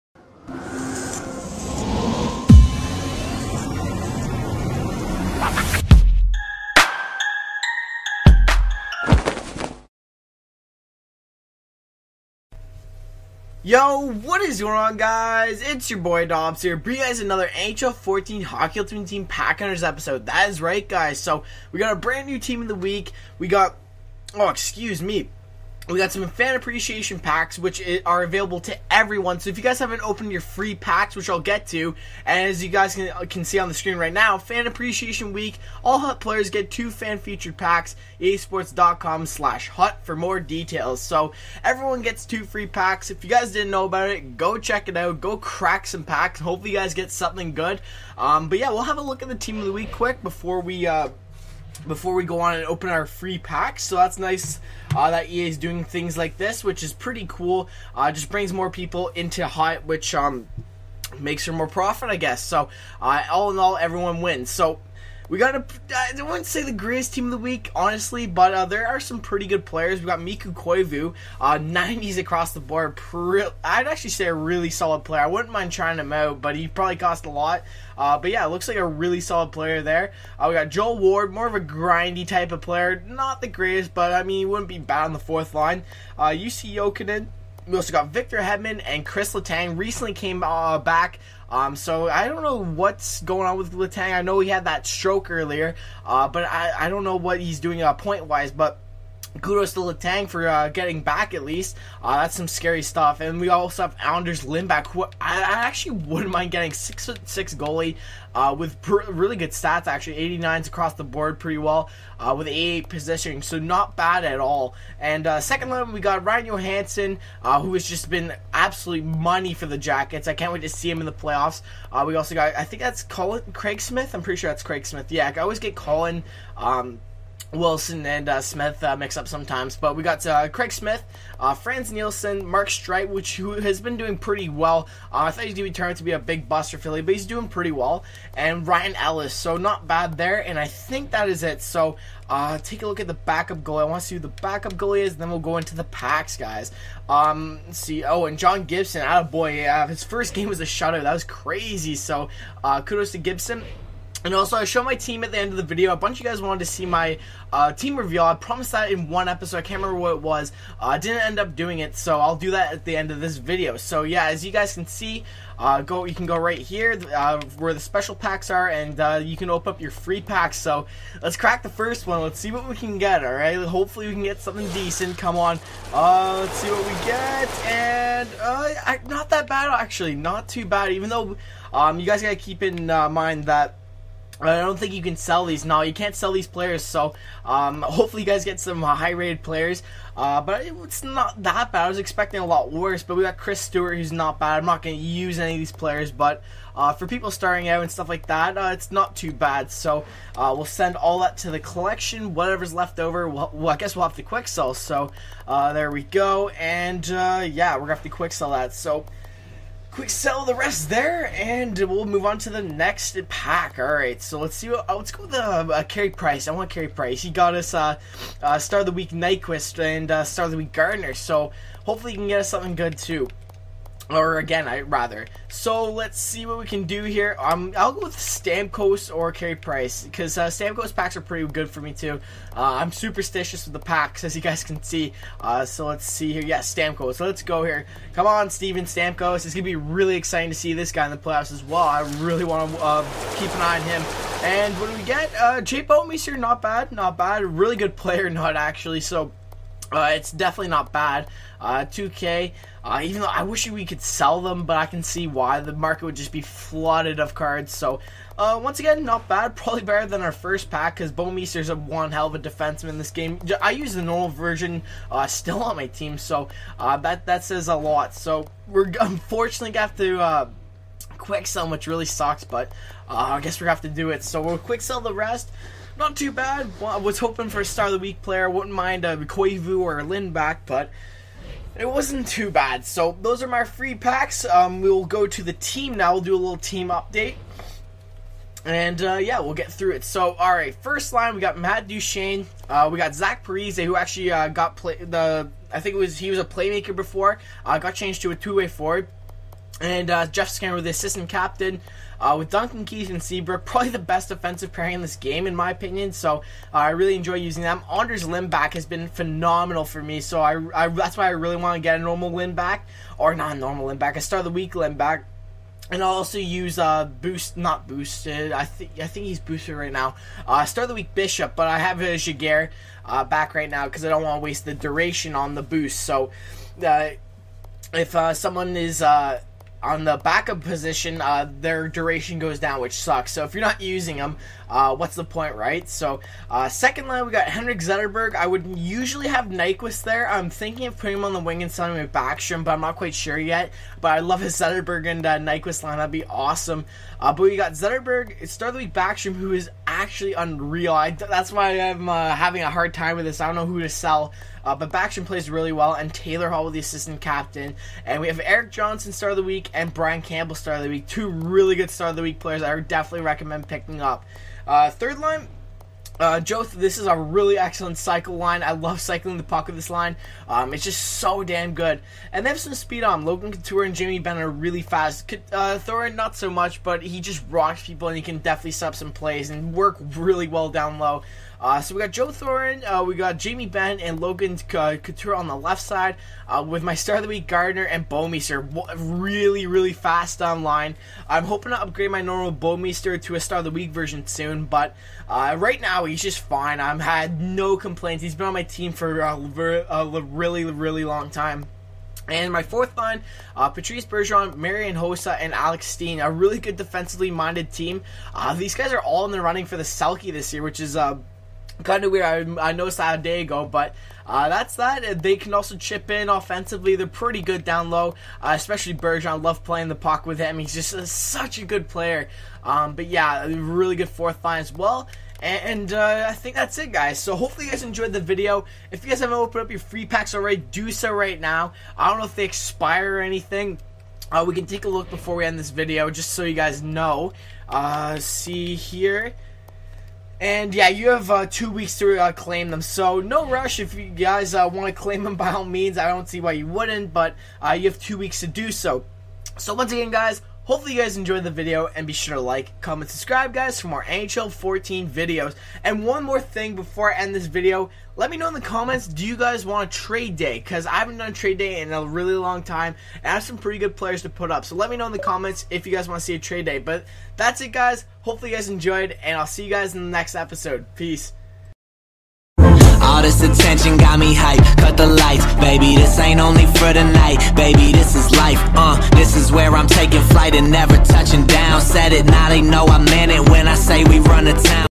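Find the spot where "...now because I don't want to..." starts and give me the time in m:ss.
5:23.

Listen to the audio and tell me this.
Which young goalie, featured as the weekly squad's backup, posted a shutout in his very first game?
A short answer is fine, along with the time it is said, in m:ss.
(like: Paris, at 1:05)
John Gibson, at 2:28.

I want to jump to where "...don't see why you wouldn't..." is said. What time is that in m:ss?
7:26.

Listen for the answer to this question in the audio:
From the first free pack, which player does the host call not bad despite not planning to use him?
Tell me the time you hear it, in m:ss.
3:13.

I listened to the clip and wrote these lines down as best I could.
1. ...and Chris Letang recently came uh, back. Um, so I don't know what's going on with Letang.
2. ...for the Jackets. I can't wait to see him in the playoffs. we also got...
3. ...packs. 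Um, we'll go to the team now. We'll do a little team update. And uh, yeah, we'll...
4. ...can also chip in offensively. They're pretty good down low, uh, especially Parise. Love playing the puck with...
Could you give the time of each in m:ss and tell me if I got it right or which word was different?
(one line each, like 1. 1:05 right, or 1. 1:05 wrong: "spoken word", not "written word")
1. 1:28 right
2. 1:59 right
3. 4:43 right
4. 6:55 wrong: "Bergeron", not "Parise".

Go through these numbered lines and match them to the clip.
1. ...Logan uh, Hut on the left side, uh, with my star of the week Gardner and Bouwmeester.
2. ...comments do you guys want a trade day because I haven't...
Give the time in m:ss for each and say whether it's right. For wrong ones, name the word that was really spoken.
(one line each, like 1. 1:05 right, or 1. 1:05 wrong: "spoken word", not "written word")
1. 6:24 wrong: "Couture", not "Hut"
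2. 7:38 right.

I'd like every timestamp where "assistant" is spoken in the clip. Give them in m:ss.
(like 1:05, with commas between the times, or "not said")
5:00, 5:56.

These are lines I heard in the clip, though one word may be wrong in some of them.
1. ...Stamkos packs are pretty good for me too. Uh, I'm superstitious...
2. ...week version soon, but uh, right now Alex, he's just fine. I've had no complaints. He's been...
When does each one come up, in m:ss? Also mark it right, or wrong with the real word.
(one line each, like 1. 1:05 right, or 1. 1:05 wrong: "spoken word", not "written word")
1. 3:50 right
2. 6:33 wrong: "Wow", not "Alex".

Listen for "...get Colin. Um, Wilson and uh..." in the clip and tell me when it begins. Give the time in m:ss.
2:05.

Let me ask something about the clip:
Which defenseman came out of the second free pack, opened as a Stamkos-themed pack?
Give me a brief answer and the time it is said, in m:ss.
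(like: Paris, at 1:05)
Jay Bouwmeester, at 4:05.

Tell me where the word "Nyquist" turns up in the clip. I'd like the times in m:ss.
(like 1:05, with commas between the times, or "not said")
3:39, 5:39, 5:45.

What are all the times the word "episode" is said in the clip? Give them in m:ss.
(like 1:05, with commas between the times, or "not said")
0:19, 2:39, 7:50.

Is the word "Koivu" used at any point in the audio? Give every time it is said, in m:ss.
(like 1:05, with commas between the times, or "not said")
1:10, 4:39.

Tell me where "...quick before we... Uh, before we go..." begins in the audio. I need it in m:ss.
0:49.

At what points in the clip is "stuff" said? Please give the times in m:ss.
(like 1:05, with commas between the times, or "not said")
1:42, 3:17.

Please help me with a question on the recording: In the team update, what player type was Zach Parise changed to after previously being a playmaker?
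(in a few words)
two-way forward.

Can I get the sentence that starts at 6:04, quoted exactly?
Uh, third line, uh, Joth, this is a really excellent cycle line.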